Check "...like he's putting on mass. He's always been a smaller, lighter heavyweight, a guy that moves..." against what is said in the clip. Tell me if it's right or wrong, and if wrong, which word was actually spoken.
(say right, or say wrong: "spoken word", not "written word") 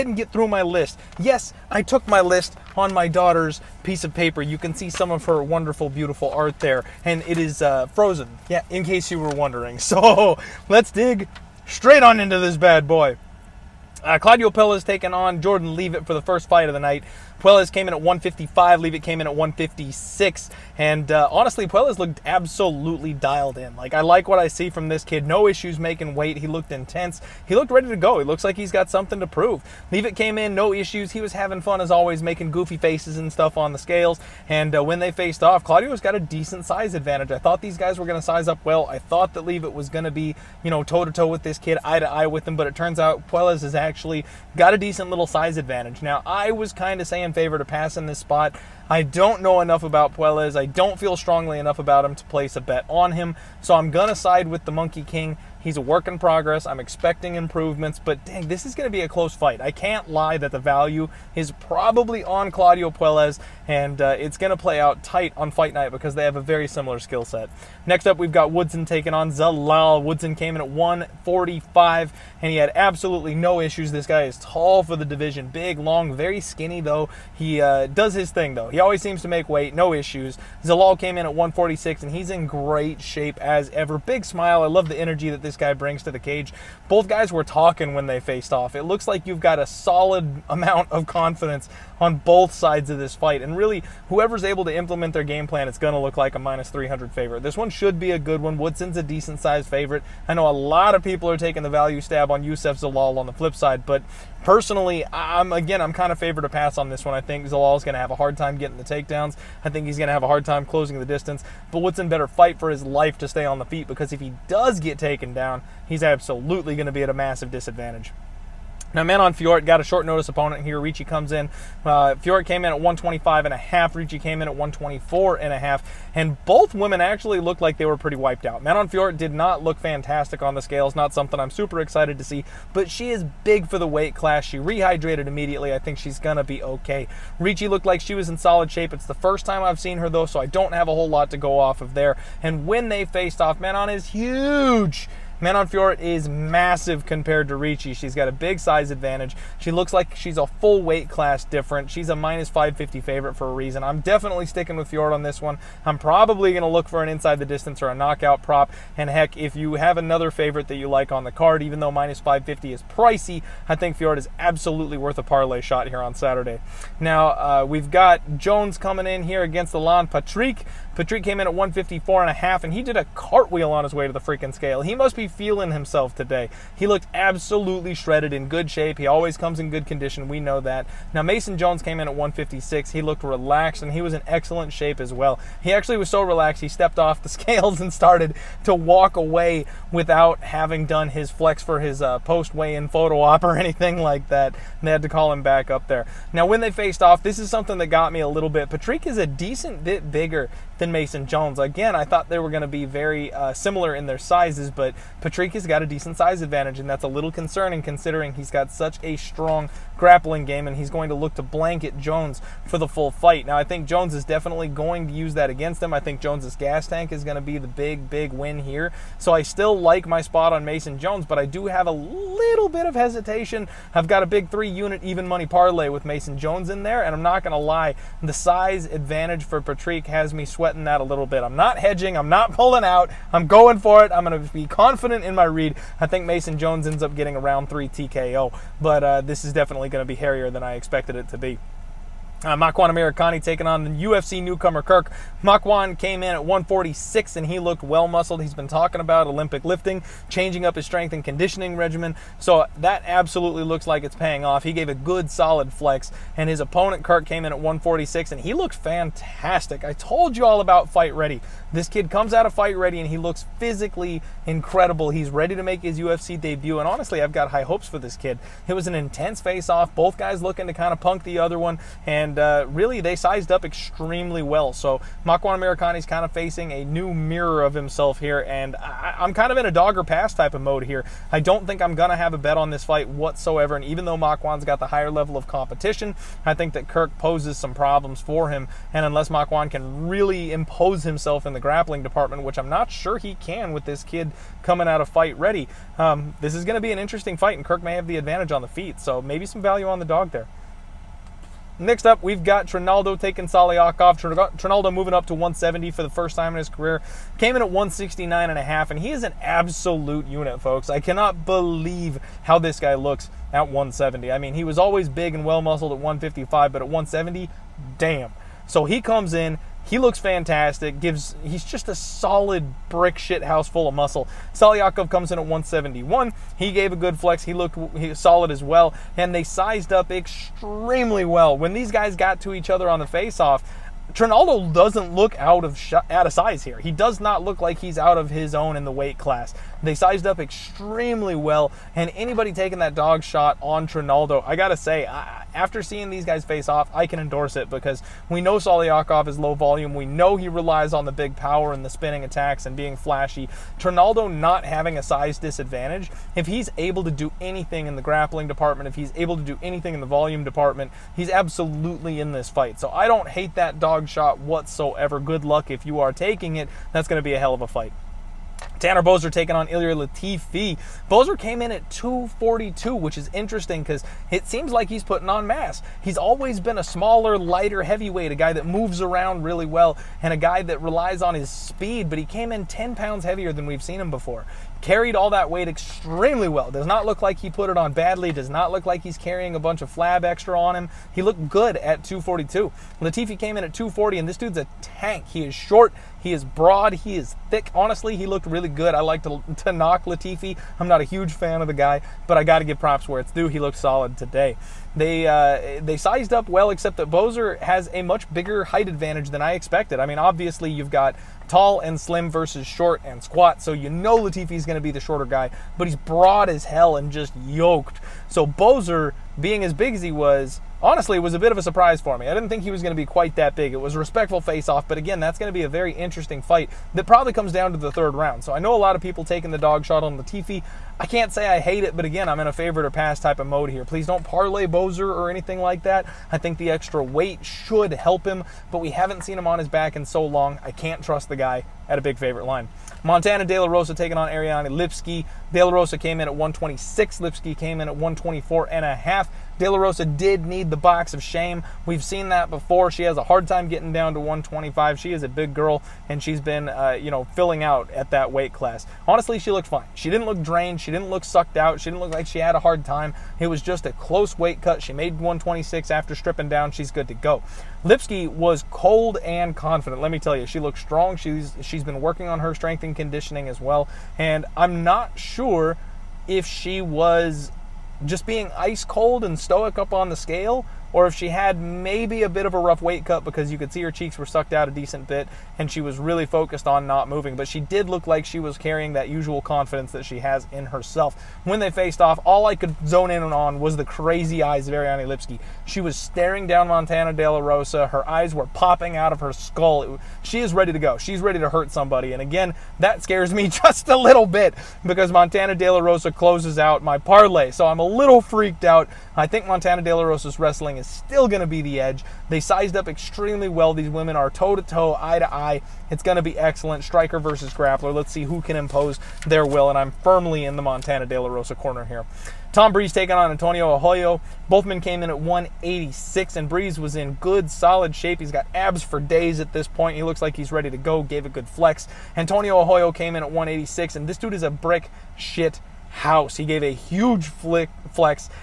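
right.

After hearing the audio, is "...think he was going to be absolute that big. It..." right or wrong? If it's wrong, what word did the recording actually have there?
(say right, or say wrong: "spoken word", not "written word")
wrong: "quite", not "absolute".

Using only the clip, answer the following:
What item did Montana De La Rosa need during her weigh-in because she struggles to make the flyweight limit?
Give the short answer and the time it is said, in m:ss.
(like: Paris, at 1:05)
the box of shame, at 7:30.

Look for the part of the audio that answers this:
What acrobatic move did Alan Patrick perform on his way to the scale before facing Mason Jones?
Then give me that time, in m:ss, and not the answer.
2:53.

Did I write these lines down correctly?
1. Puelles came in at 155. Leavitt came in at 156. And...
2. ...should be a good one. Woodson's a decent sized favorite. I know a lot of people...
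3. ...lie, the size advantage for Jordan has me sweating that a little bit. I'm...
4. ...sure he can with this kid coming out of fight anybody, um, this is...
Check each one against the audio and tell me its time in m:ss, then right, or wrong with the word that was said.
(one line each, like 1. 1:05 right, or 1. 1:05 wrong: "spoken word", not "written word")
1. 0:17 right
2. 1:37 right
3. 3:47 wrong: "Patrick", not "Jordan"
4. 4:52 wrong: "ready", not "anybody".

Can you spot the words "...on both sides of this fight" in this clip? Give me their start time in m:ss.
1:31.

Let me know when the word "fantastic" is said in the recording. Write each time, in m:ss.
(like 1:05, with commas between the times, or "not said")
2:09, 4:18, 5:20.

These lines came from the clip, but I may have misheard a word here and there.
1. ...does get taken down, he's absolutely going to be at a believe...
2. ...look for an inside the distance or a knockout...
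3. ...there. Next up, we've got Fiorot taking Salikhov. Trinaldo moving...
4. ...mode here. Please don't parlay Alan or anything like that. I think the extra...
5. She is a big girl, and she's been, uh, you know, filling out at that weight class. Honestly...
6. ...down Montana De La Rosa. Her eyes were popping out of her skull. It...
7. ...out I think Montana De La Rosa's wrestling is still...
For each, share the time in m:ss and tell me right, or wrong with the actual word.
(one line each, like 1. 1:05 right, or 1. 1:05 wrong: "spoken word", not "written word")
1. 1:54 wrong: "massive", not "believe"
2. 2:36 right
3. 5:00 wrong: "Trinaldo", not "Fiorot"
4. 7:13 wrong: "Boser", not "Alan"
5. 7:34 right
6. 8:16 right
7. 8:28 right.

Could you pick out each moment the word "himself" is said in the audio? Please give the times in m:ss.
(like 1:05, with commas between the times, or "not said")
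2:55, 4:37, 4:51.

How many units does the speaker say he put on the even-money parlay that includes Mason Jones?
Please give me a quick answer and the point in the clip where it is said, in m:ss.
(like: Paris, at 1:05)
3 units, at 3:44.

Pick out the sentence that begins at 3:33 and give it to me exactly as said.
Now, I think Jones is definitely going to use that against him.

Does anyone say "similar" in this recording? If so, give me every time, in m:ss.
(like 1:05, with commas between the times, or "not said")
1:06, 3:23.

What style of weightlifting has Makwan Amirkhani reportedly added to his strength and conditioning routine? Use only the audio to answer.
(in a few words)
Olympic lifting.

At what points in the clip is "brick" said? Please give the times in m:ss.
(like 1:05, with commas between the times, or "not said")
5:22, 8:54.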